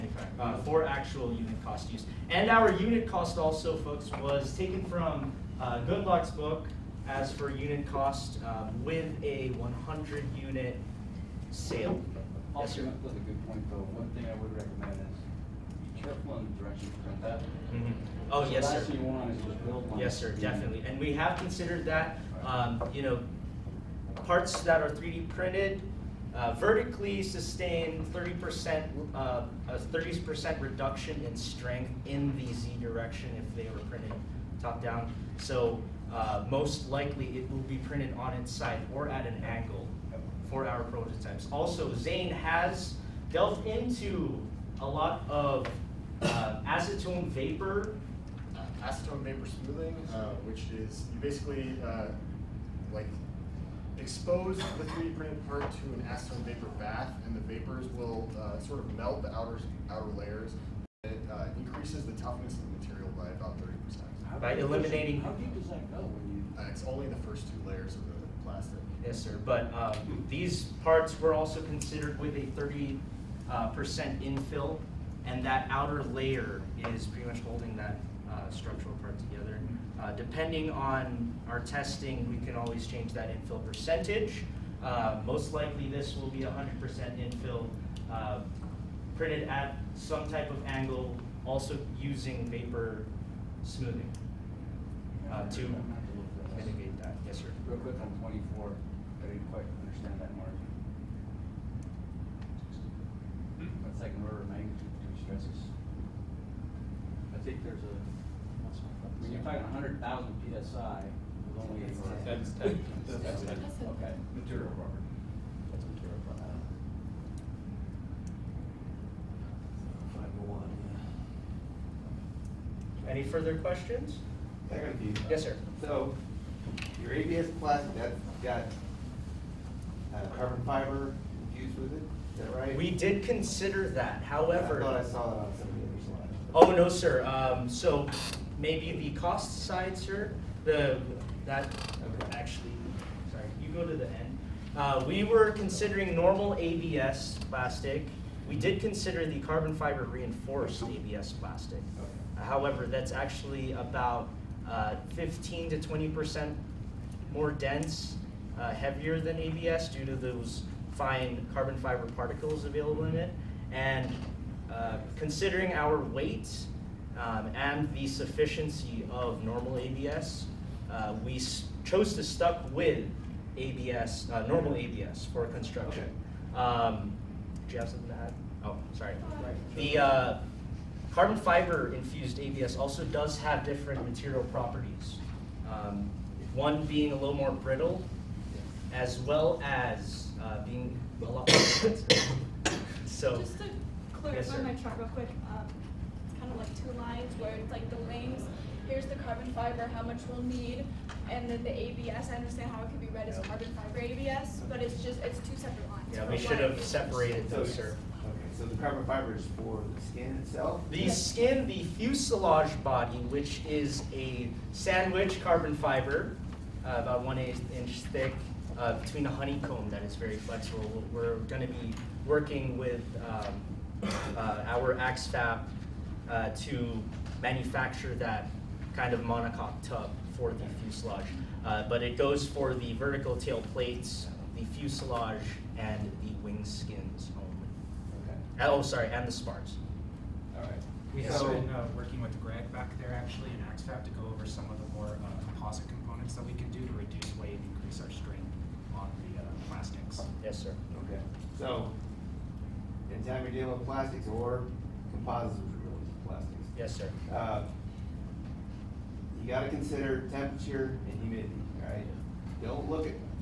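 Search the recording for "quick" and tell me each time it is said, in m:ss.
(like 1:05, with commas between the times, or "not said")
1:37, 3:15.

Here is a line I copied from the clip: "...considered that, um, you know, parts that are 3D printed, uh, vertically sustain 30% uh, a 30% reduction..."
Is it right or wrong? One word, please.
right.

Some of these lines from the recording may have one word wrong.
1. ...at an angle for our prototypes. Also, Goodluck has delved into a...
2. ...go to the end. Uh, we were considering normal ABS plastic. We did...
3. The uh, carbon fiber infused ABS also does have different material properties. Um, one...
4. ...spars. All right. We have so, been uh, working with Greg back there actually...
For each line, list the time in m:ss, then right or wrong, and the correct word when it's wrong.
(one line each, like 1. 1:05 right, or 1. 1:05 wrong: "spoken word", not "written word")
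1. 0:39 wrong: "Zane", not "Goodluck"
2. 2:23 right
3. 2:59 right
4. 3:59 right.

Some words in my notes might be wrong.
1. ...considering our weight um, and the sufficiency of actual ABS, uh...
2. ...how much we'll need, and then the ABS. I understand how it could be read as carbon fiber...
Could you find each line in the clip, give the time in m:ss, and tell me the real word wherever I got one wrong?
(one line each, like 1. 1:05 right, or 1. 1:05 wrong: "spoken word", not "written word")
1. 2:45 wrong: "normal", not "actual"
2. 3:19 right.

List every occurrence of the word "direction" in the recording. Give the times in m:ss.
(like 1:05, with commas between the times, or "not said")
0:16, 0:32.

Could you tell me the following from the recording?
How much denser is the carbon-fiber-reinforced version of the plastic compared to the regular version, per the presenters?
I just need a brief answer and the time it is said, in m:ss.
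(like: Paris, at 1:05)
15-20%, at 2:35.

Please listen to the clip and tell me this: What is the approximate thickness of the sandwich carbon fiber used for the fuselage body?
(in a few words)
1/8 inch.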